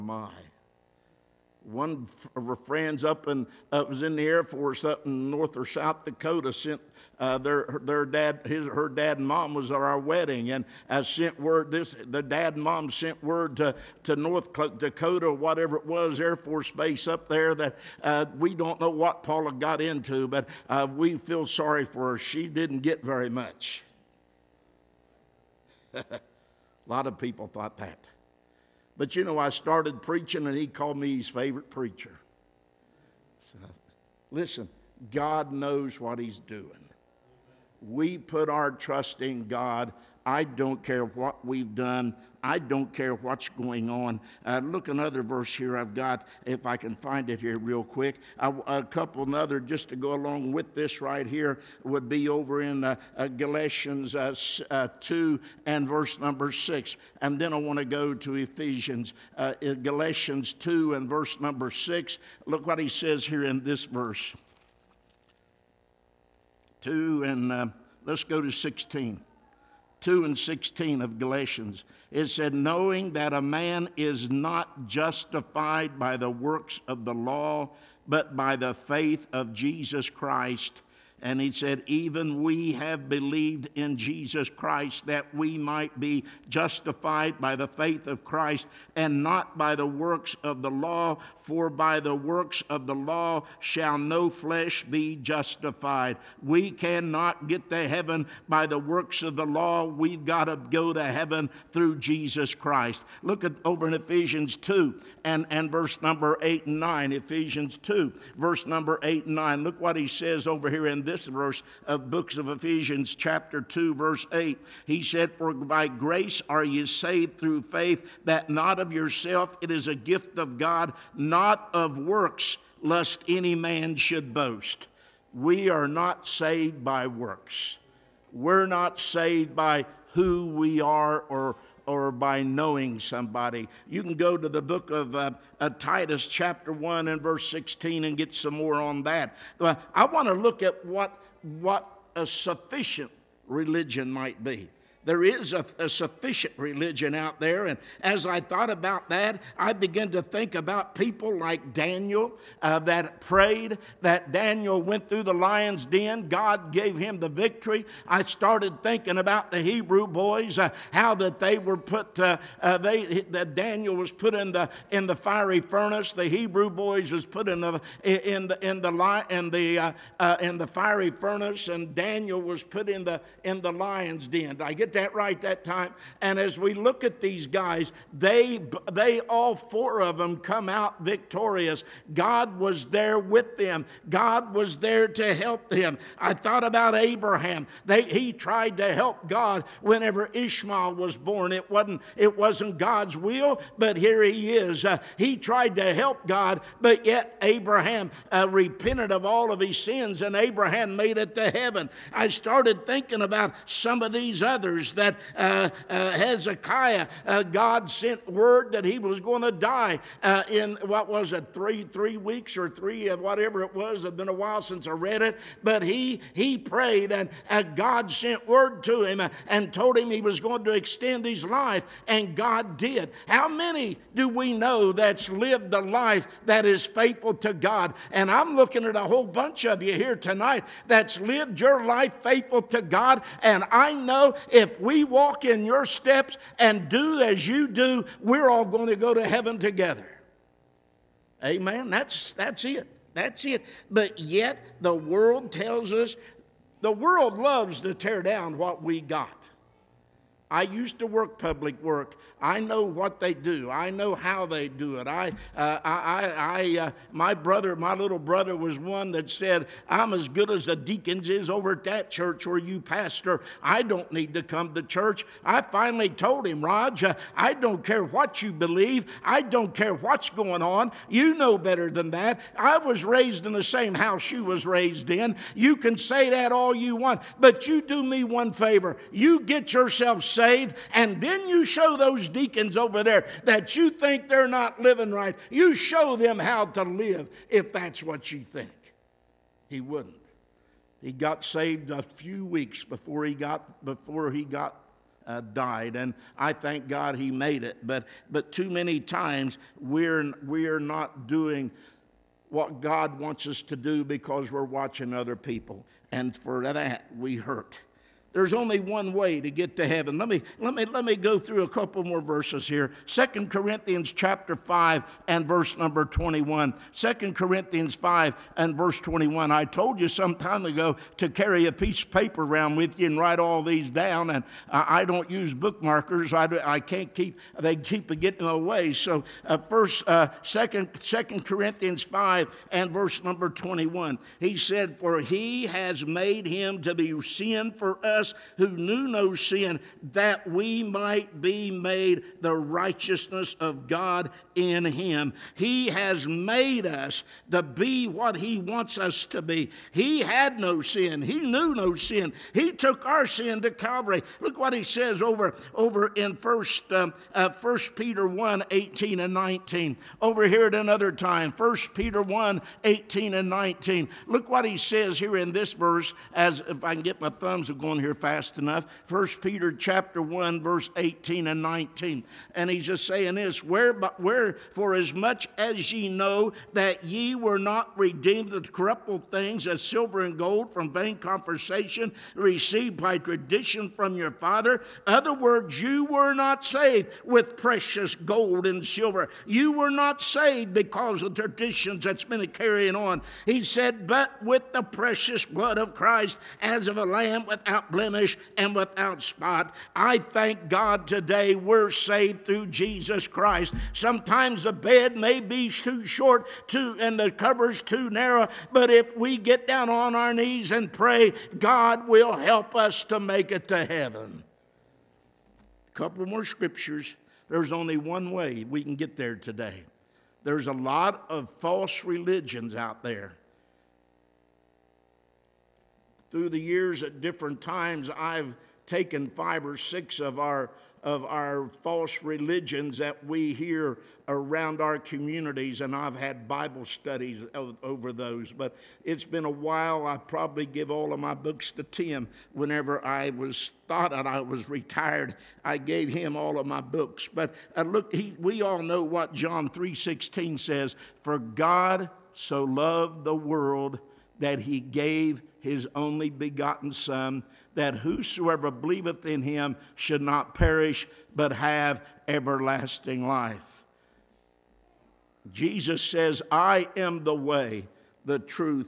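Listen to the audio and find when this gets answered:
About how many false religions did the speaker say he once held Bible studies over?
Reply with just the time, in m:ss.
7:09.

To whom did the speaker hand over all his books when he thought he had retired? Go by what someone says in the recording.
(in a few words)
Tim.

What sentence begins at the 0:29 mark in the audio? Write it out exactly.
But you know, I started preaching and he called me his favorite preacher.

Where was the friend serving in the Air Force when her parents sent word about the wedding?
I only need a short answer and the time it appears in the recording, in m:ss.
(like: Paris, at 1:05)
North Dakota, at 0:14.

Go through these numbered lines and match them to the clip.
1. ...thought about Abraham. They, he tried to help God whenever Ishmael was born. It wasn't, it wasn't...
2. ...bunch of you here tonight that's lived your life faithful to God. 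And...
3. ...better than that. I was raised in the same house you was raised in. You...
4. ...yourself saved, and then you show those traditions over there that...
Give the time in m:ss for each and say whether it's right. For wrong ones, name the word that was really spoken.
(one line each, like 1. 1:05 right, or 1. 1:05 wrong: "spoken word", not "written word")
1. 3:06 right
2. 3:49 right
3. 4:31 right
4. 4:39 wrong: "deacons", not "traditions".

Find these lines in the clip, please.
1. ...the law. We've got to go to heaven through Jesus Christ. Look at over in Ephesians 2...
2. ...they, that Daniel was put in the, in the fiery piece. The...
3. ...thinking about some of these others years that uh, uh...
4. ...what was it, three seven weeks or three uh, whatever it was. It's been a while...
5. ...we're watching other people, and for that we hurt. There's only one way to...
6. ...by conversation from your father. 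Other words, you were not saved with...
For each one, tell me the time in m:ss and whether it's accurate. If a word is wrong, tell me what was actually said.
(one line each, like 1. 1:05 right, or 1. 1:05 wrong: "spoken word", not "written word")
1. 1:39 right
2. 2:42 wrong: "furnace", not "piece"
3. 3:22 right
4. 3:30 wrong: "three", not "seven"
5. 5:04 right
6. 6:23 wrong: "tradition", not "conversation".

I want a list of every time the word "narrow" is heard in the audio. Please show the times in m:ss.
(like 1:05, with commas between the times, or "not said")
6:48.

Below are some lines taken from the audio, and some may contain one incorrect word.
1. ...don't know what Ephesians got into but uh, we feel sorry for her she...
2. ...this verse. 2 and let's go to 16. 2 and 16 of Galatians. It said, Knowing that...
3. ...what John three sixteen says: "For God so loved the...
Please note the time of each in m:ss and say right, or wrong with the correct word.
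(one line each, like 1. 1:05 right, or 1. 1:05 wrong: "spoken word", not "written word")
1. 0:18 wrong: "Paula", not "Ephesians"
2. 1:03 right
3. 7:29 right.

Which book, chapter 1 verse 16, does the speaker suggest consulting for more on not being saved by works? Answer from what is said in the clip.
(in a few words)
Titus.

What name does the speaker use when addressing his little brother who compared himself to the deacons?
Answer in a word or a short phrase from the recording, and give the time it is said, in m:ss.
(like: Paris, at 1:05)
Raj, at 4:26.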